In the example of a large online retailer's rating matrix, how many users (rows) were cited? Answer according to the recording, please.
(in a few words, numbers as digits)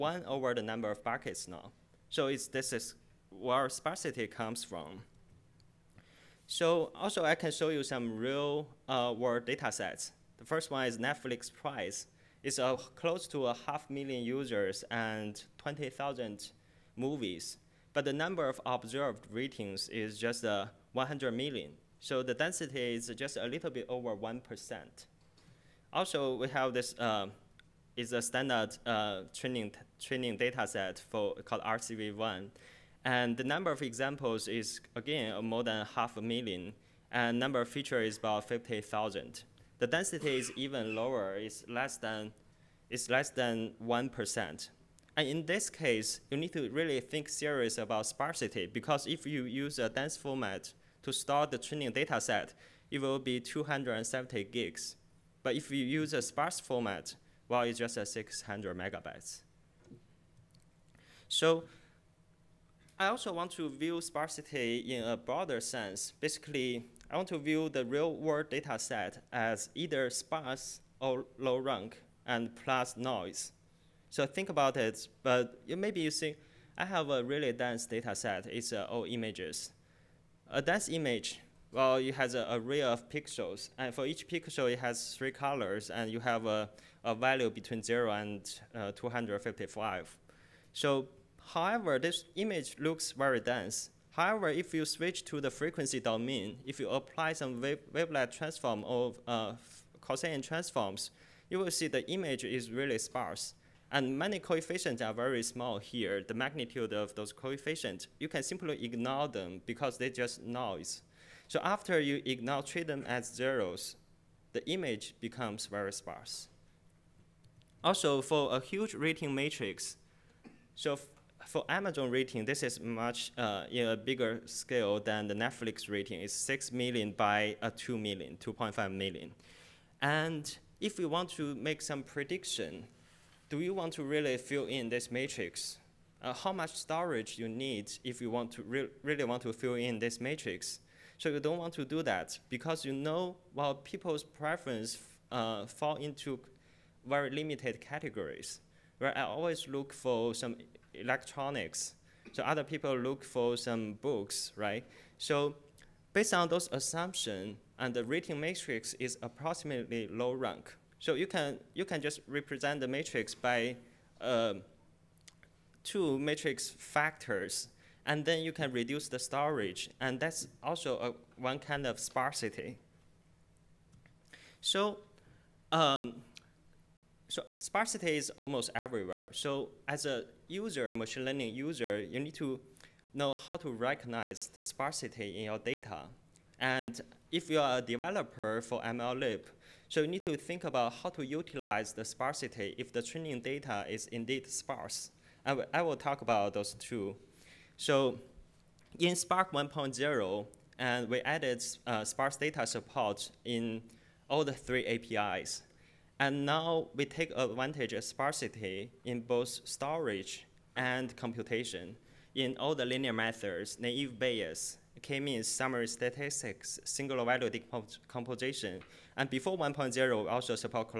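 6 million.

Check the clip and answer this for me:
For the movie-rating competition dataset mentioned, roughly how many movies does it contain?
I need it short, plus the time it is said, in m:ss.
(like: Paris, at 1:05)
20,000, at 0:15.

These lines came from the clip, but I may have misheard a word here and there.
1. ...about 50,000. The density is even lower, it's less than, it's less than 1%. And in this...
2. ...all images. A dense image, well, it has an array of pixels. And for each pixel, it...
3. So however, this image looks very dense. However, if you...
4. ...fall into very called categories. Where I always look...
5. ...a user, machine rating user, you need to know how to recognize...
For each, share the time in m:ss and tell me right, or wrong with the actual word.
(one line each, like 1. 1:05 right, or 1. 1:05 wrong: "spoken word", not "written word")
1. 0:38 right
2. 1:18 right
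3. 1:30 right
4. 2:25 wrong: "limited", not "called"
5. 3:00 wrong: "learning", not "rating".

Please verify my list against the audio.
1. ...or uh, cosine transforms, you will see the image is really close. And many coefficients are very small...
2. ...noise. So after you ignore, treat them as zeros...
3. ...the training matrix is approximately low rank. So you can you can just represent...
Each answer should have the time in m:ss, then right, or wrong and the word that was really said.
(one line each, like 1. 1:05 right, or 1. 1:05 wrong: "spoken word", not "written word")
1. 1:38 wrong: "sparse", not "close"
2. 1:50 right
3. 2:37 wrong: "rating", not "training".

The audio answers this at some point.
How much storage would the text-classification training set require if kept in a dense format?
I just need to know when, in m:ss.
0:53.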